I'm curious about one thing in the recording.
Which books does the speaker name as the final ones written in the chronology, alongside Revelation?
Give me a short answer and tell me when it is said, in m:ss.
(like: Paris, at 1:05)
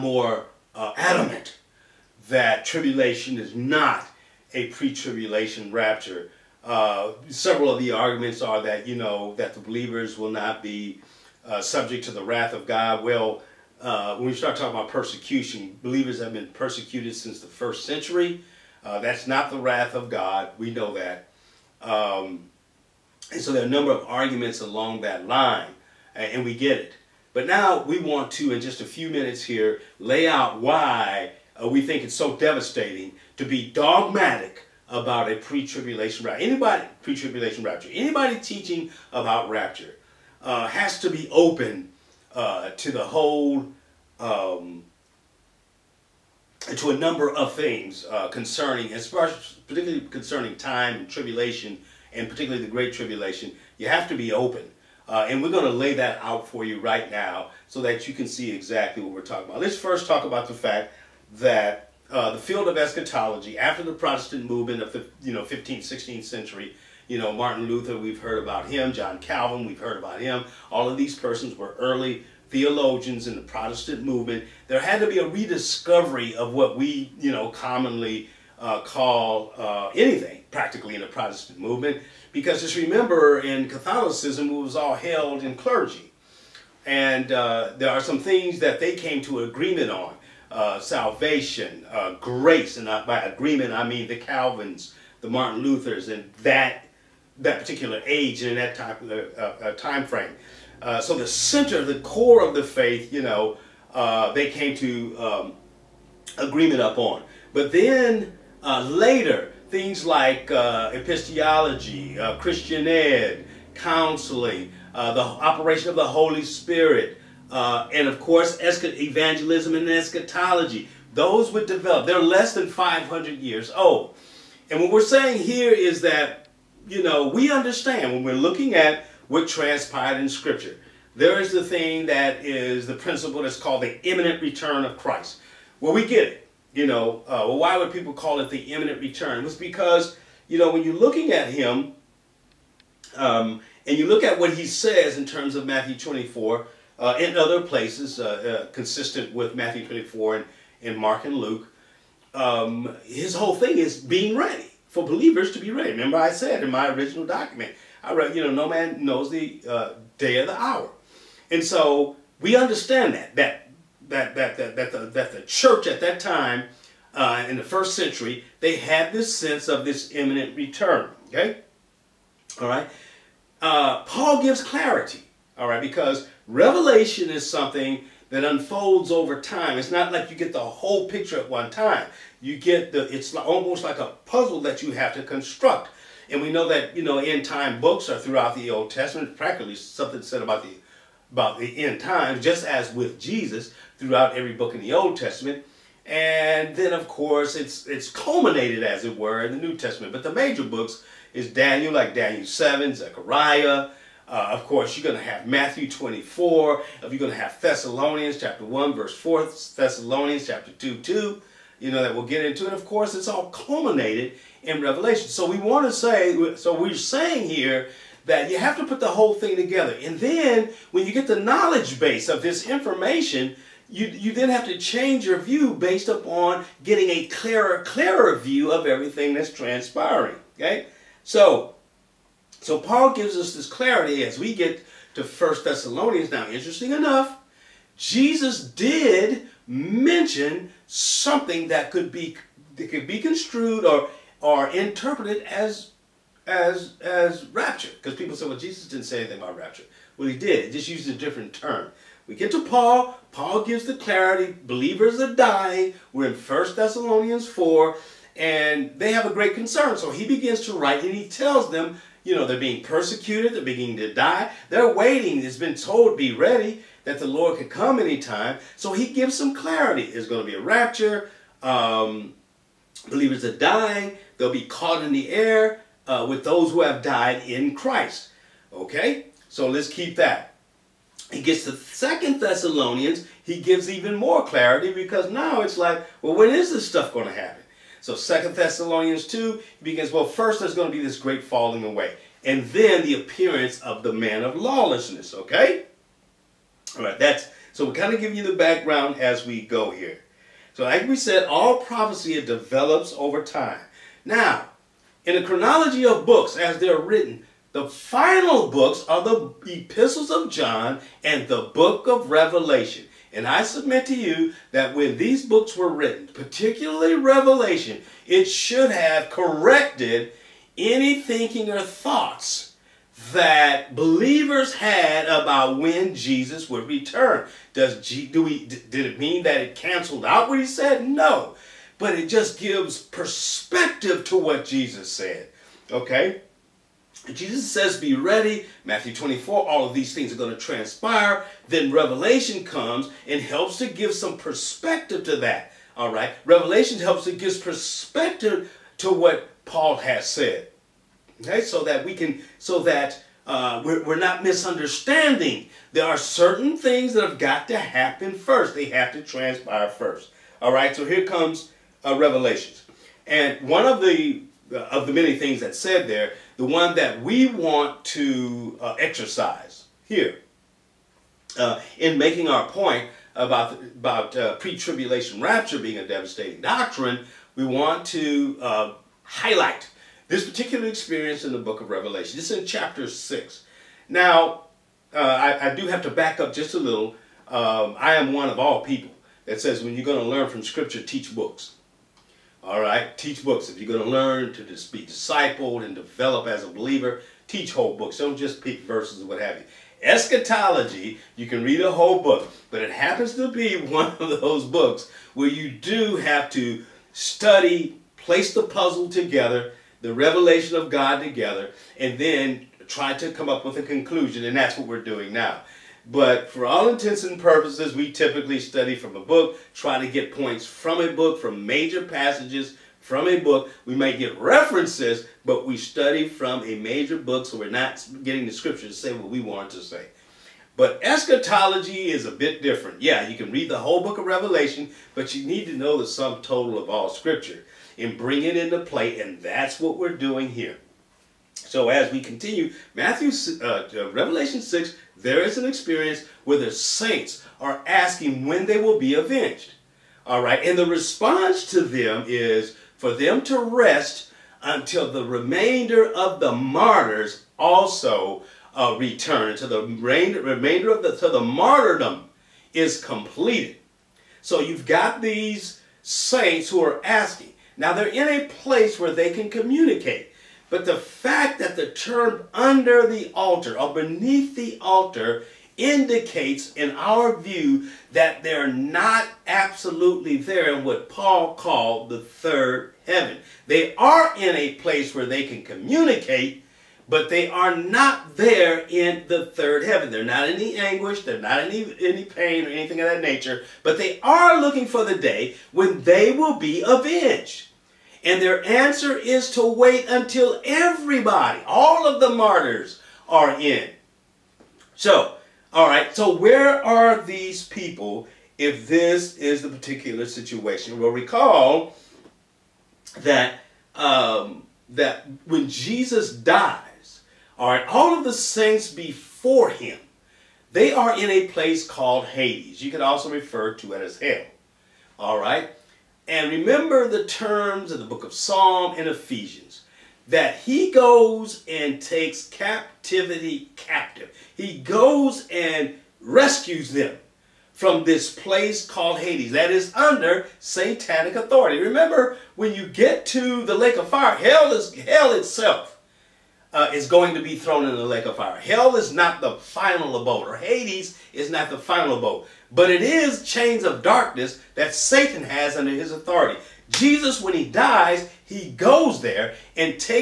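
epistles of John, at 5:09.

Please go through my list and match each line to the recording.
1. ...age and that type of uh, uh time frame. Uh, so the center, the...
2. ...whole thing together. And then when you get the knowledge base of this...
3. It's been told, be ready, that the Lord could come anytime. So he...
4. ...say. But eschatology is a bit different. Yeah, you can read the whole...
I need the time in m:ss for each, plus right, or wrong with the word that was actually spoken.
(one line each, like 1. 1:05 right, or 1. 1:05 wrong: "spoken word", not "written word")
1. 1:38 right
2. 3:39 right
3. 4:25 right
4. 7:09 right.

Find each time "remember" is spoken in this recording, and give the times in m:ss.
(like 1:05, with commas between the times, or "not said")
1:22, 2:35, 8:46, 9:01.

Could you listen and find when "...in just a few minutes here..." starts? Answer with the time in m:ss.
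0:28.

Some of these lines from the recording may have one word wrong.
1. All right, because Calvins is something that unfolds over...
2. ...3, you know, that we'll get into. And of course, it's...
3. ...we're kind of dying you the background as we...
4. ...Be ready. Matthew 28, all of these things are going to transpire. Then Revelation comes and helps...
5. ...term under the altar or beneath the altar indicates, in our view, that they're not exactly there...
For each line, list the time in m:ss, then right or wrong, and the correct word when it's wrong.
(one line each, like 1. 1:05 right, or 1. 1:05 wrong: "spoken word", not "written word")
1. 2:55 wrong: "Revelation", not "Calvins"
2. 3:30 wrong: "2", not "3"
3. 4:57 wrong: "giving", not "dying"
4. 5:37 wrong: "24", not "28"
5. 7:51 wrong: "absolutely", not "exactly".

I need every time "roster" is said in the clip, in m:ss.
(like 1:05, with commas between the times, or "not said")
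not said.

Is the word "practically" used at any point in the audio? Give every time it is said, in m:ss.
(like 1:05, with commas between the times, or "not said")
1:20, 3:09.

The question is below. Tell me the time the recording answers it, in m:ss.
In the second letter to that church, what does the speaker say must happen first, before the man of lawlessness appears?
4:51.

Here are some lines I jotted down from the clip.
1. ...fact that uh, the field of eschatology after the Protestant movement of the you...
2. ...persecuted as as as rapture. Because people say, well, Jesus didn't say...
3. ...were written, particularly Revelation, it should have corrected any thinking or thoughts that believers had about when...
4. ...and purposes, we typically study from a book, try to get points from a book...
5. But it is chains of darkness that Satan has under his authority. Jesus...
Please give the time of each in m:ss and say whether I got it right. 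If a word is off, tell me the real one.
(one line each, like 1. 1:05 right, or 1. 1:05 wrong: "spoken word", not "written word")
1. 1:00 right
2. 4:04 wrong: "interpreted", not "persecuted"
3. 5:15 right
4. 6:57 right
5. 9:12 right.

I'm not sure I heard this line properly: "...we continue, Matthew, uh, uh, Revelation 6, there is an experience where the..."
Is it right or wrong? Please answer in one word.
right.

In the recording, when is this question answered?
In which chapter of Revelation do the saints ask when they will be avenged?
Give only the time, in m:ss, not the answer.
6:22.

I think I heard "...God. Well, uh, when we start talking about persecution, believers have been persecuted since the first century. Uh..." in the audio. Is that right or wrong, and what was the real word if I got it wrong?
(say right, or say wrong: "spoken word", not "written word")
right.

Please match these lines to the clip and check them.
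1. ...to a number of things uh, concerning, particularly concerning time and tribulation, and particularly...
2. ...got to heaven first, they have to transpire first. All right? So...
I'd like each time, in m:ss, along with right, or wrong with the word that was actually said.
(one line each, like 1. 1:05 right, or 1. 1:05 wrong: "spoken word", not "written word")
1. 0:46 right
2. 5:57 wrong: "happen", not "heaven".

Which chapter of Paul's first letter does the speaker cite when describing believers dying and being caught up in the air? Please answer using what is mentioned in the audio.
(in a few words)
First Thessalonians 4.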